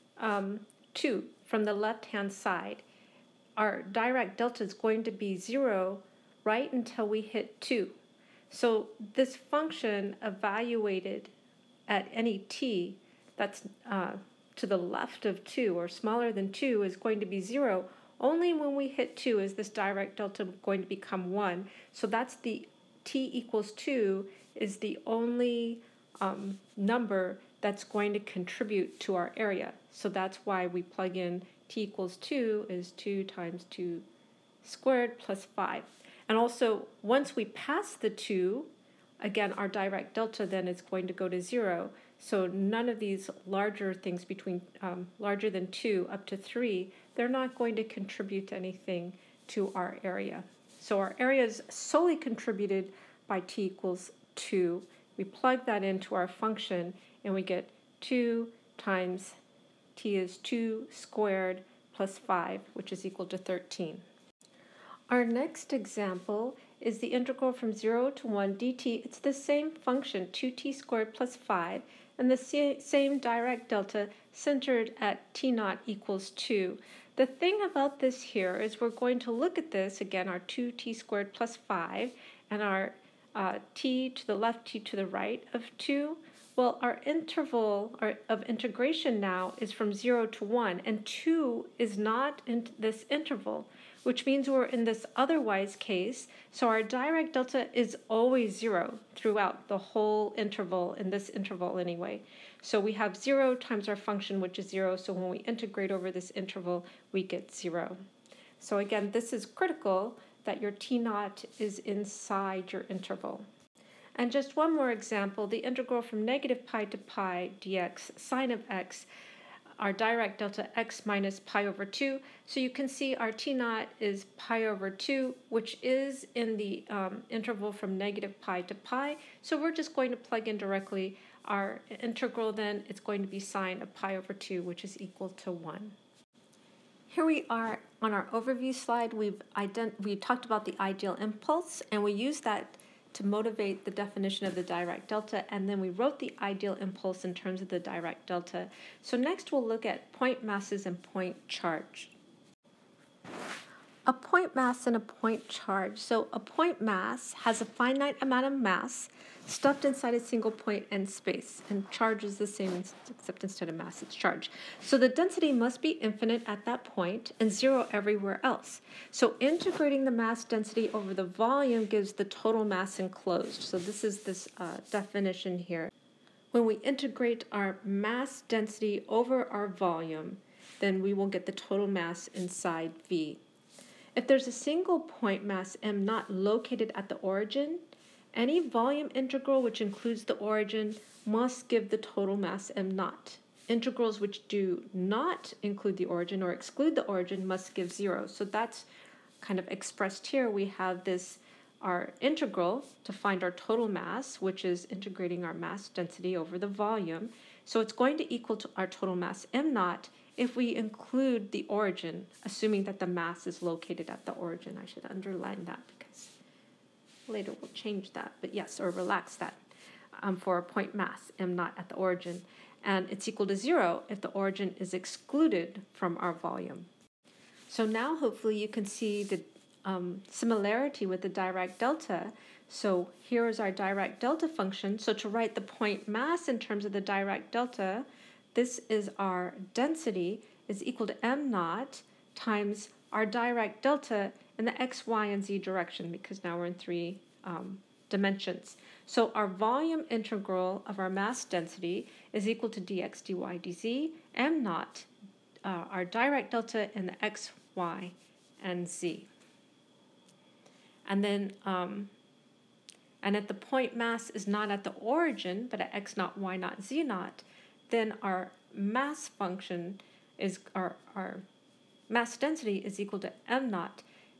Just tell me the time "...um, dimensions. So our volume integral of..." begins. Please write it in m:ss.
4:07.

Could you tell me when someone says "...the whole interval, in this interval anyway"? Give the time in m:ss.
1:39.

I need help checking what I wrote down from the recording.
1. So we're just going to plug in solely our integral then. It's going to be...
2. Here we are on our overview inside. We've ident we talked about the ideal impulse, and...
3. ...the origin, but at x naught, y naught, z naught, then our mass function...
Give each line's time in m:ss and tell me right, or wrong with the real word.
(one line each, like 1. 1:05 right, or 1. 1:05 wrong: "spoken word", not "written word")
1. 2:09 wrong: "directly", not "solely"
2. 2:17 wrong: "slide", not "inside"
3. 4:24 right.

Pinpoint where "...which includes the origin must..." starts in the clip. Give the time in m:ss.
3:09.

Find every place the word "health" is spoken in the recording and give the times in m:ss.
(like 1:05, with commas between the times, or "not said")
not said.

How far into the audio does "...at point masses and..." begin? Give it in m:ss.
2:29.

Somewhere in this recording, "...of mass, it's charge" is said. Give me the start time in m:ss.
2:43.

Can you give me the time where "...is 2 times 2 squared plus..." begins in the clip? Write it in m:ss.
0:32.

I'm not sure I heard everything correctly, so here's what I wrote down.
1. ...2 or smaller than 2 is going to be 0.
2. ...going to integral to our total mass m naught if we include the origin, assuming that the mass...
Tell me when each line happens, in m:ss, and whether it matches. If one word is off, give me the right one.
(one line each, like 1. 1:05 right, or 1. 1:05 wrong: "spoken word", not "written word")
1. 0:15 right
2. 3:27 wrong: "equal", not "integral".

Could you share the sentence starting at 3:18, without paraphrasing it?
So that's kind of expressed here.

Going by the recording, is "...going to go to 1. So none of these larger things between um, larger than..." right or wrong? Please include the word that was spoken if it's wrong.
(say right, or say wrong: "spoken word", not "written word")
wrong: "0", not "1".